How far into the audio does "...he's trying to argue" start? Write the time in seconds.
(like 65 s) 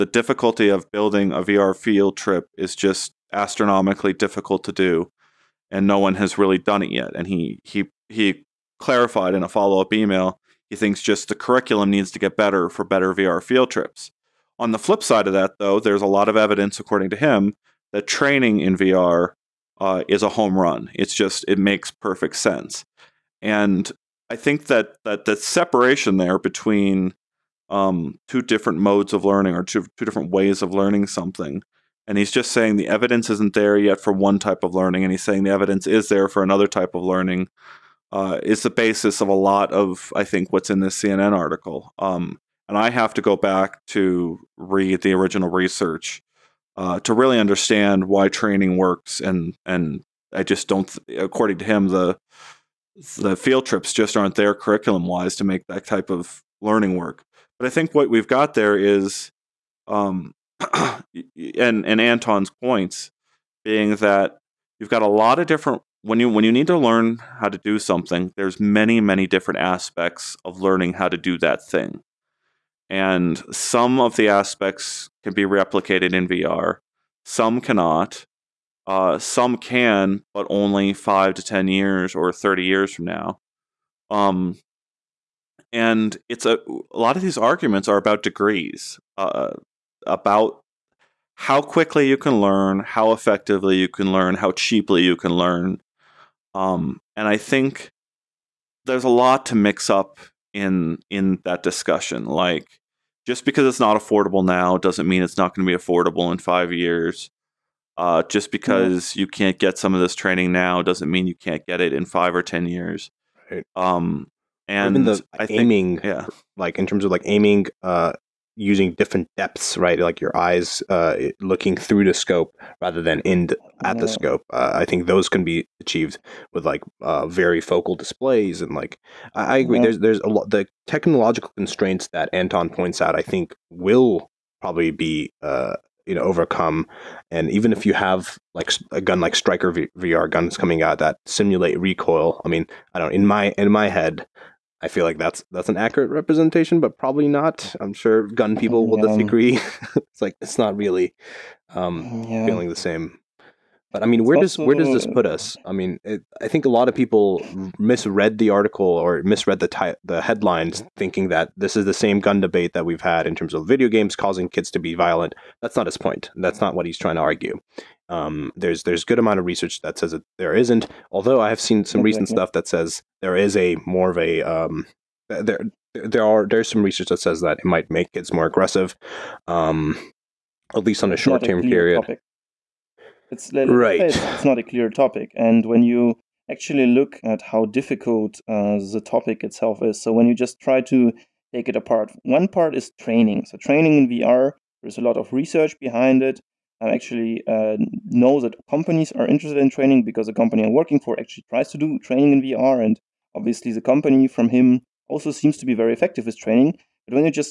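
166 s.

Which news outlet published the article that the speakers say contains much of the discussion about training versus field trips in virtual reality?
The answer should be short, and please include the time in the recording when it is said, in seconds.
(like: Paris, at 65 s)
CNN, at 40 s.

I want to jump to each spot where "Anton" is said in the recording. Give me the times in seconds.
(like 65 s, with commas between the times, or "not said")
61 s, 132 s.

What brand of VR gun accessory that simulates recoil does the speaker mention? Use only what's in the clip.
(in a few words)
Striker.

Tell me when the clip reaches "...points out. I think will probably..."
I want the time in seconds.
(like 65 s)
132 s.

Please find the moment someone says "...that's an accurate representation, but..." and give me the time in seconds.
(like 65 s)
145 s.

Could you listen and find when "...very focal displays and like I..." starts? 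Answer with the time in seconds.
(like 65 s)
127 s.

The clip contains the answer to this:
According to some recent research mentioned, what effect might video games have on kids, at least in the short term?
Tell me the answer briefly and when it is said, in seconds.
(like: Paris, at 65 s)
More aggressive, at 178 s.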